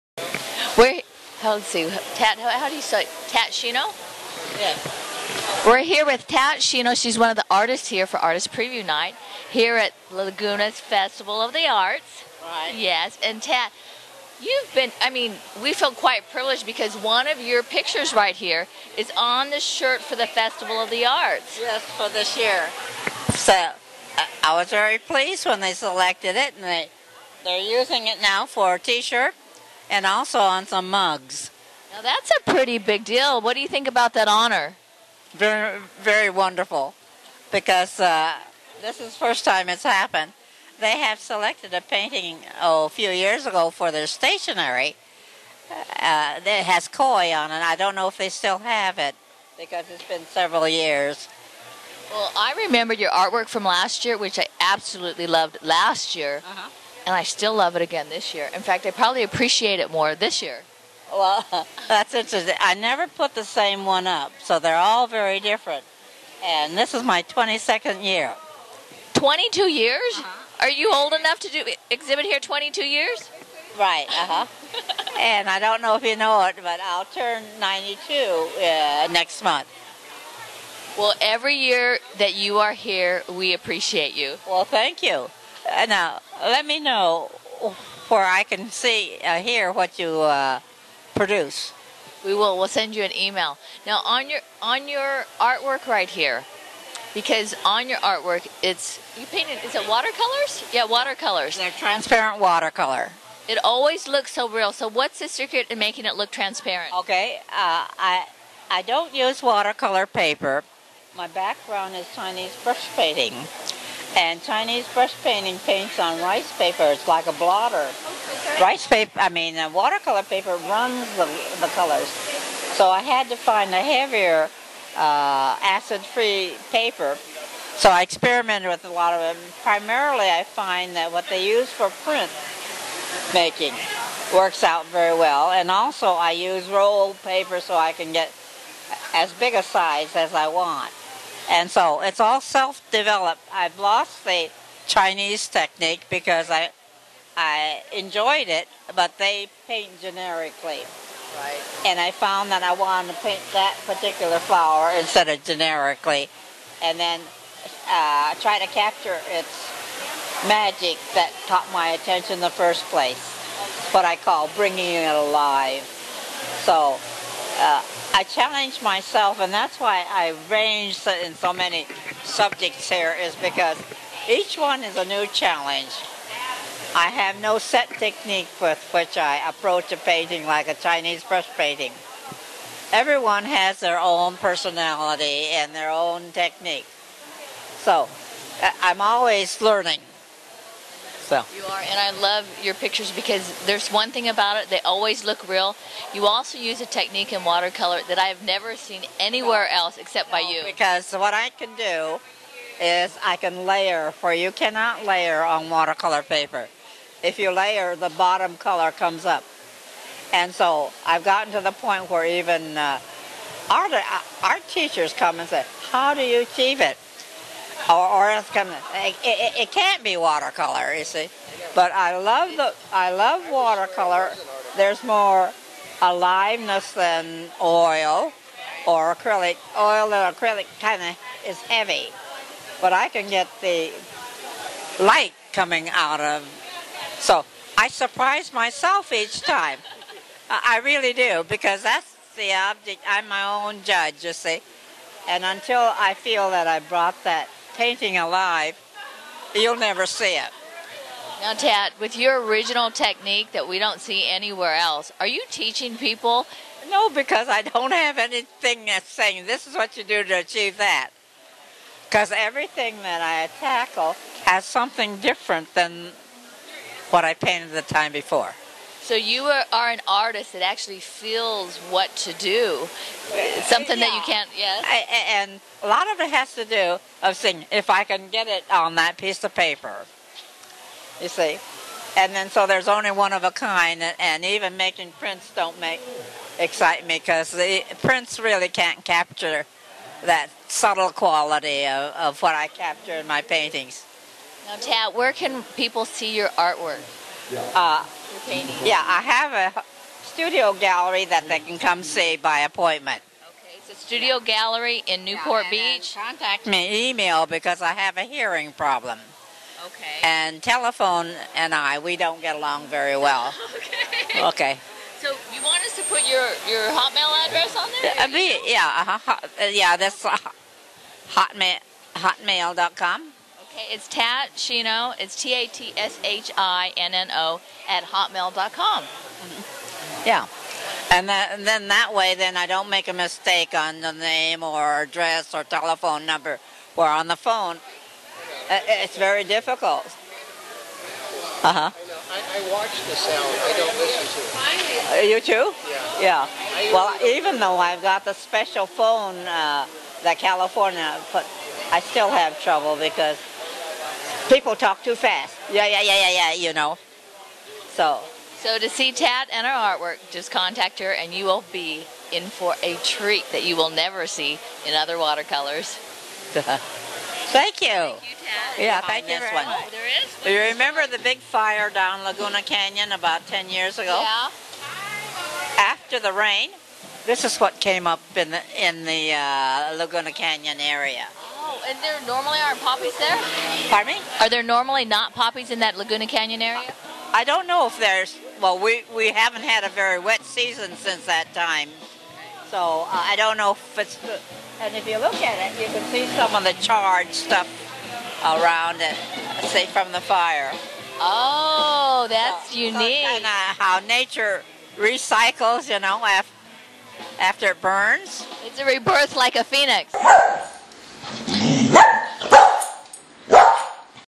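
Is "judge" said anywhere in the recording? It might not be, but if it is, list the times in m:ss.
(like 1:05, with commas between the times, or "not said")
4:03.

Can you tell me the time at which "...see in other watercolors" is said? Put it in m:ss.
6:04.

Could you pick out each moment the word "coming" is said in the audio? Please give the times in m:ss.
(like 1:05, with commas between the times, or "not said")
3:38, 3:55.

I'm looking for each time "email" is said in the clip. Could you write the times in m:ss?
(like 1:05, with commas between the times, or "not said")
1:33, 5:07.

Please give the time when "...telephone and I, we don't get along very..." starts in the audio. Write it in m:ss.
5:10.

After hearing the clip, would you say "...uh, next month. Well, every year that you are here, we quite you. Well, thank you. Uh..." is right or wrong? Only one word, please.
wrong.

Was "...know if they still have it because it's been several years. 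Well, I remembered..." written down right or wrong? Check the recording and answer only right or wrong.
right.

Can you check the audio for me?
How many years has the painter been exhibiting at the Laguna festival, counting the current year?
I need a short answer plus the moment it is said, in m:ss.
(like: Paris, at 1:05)
22, at 1:07.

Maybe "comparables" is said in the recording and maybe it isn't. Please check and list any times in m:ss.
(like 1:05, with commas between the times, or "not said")
not said.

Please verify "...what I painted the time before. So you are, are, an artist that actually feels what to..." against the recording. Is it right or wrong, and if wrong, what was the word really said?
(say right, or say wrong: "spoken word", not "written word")
right.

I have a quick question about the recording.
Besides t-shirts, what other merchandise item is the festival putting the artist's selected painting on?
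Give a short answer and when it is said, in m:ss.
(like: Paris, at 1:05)
Mugs, at 0:30.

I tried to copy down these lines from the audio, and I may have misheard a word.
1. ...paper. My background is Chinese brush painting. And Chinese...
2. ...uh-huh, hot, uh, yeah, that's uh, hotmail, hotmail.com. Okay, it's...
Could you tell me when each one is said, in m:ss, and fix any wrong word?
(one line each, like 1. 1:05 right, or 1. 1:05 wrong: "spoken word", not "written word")
1. 1:50 right
2. 5:19 right.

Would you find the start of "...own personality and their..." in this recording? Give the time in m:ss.
3:03.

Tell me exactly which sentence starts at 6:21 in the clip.
And there normally aren't poppies there?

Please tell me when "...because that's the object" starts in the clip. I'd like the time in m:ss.
4:01.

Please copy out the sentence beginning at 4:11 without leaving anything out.
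Now, Tat, with your original technique that we don't see anywhere else, are you teaching people?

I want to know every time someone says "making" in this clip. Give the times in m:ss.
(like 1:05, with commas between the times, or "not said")
1:45, 2:13, 4:44.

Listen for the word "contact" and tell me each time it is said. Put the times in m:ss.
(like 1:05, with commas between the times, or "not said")
5:06, 6:00.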